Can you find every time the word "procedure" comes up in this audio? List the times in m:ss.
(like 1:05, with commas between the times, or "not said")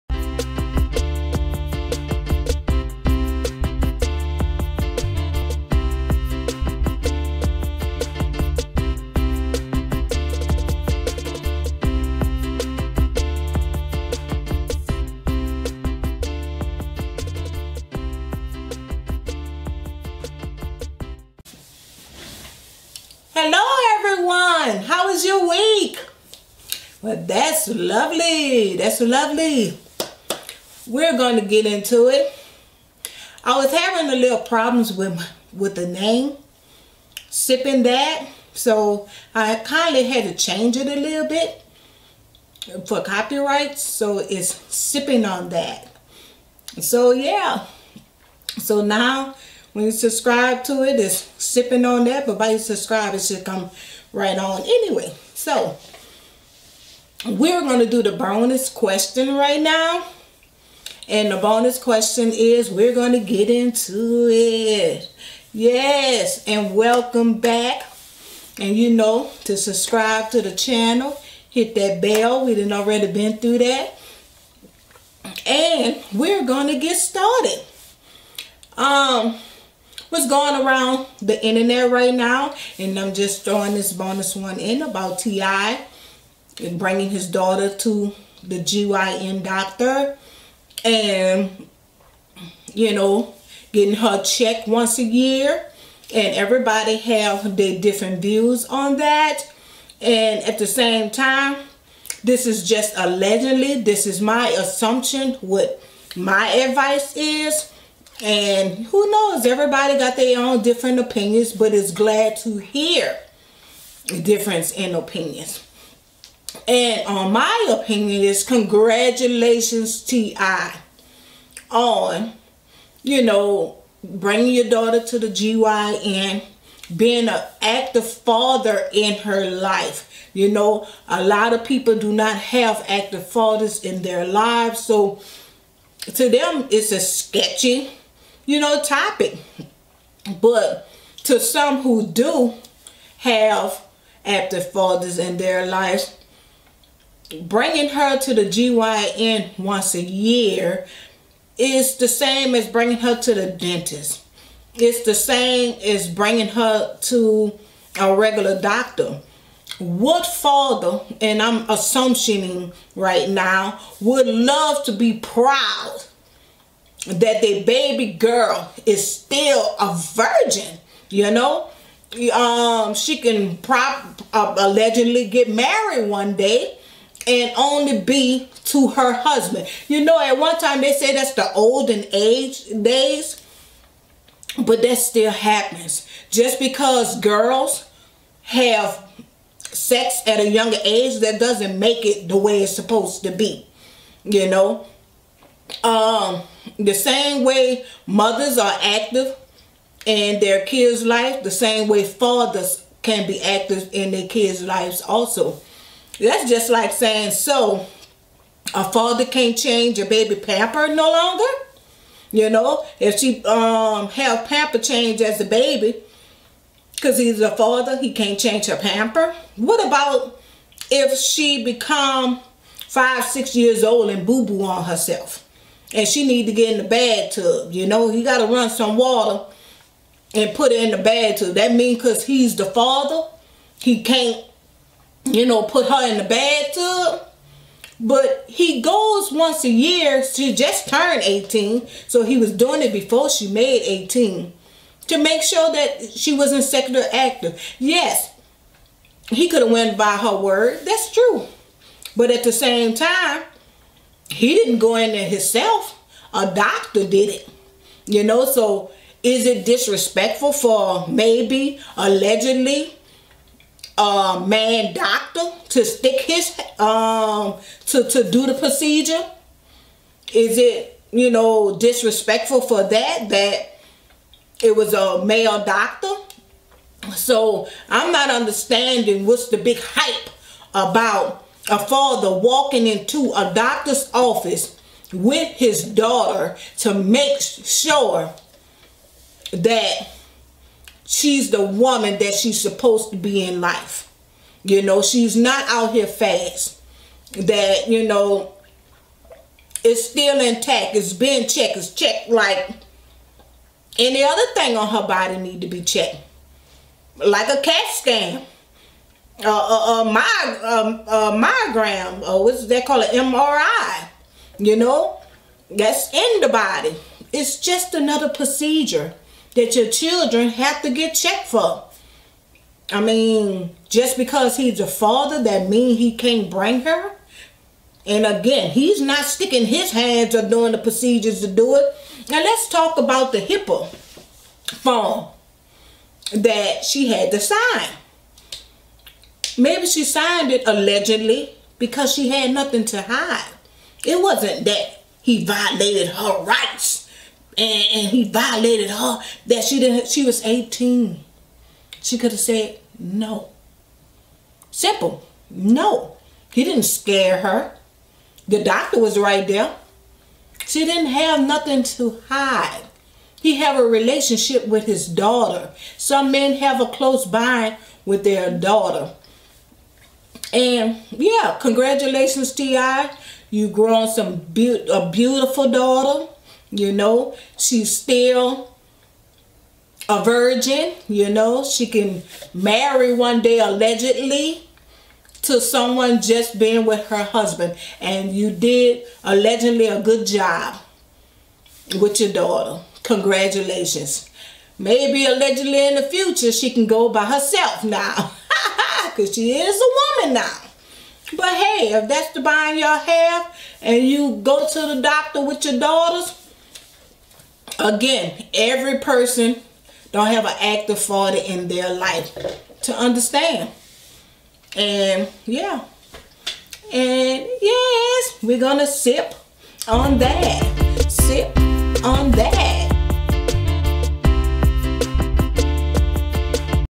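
4:28, 5:18, 5:30.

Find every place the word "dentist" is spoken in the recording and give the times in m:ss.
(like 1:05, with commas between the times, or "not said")
2:33.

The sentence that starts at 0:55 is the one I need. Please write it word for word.
So, we're going to do the bonus question right now.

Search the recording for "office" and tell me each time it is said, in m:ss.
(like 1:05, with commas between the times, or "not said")
4:44.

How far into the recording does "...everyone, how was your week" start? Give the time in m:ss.
0:24.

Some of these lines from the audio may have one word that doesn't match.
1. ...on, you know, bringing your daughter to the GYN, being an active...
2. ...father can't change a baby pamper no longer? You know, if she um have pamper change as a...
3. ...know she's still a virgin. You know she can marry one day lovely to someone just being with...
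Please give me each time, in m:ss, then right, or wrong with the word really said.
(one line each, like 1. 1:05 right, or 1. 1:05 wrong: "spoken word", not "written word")
1. 2:01 right
2. 3:28 right
3. 6:16 wrong: "allegedly", not "lovely".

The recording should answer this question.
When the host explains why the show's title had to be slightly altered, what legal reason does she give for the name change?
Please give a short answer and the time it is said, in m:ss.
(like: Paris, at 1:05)
copyright, at 0:43.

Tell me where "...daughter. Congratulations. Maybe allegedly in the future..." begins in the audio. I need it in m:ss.
6:32.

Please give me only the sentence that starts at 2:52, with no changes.
Um, she can prop uh, allegedly get married one day and only be to her husband.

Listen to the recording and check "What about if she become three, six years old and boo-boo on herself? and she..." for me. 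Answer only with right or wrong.
wrong.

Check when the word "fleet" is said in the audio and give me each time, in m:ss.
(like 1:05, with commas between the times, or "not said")
not said.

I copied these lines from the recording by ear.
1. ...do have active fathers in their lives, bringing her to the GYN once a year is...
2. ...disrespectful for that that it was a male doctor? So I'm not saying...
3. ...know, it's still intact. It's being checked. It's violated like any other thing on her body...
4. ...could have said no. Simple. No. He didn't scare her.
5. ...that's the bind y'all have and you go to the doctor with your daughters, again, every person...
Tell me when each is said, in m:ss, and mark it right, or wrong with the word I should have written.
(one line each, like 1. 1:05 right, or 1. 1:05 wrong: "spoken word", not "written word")
1. 2:22 right
2. 4:31 wrong: "understanding", not "saying"
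3. 4:58 wrong: "checked", not "violated"
4. 5:52 right
5. 6:42 right.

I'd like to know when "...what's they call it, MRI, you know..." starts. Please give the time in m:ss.
5:12.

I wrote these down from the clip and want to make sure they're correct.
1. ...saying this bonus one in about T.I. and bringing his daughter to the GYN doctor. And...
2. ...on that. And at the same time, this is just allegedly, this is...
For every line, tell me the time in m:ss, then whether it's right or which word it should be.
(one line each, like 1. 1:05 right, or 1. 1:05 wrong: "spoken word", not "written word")
1. 1:23 wrong: "throwing", not "saying"
2. 1:38 right.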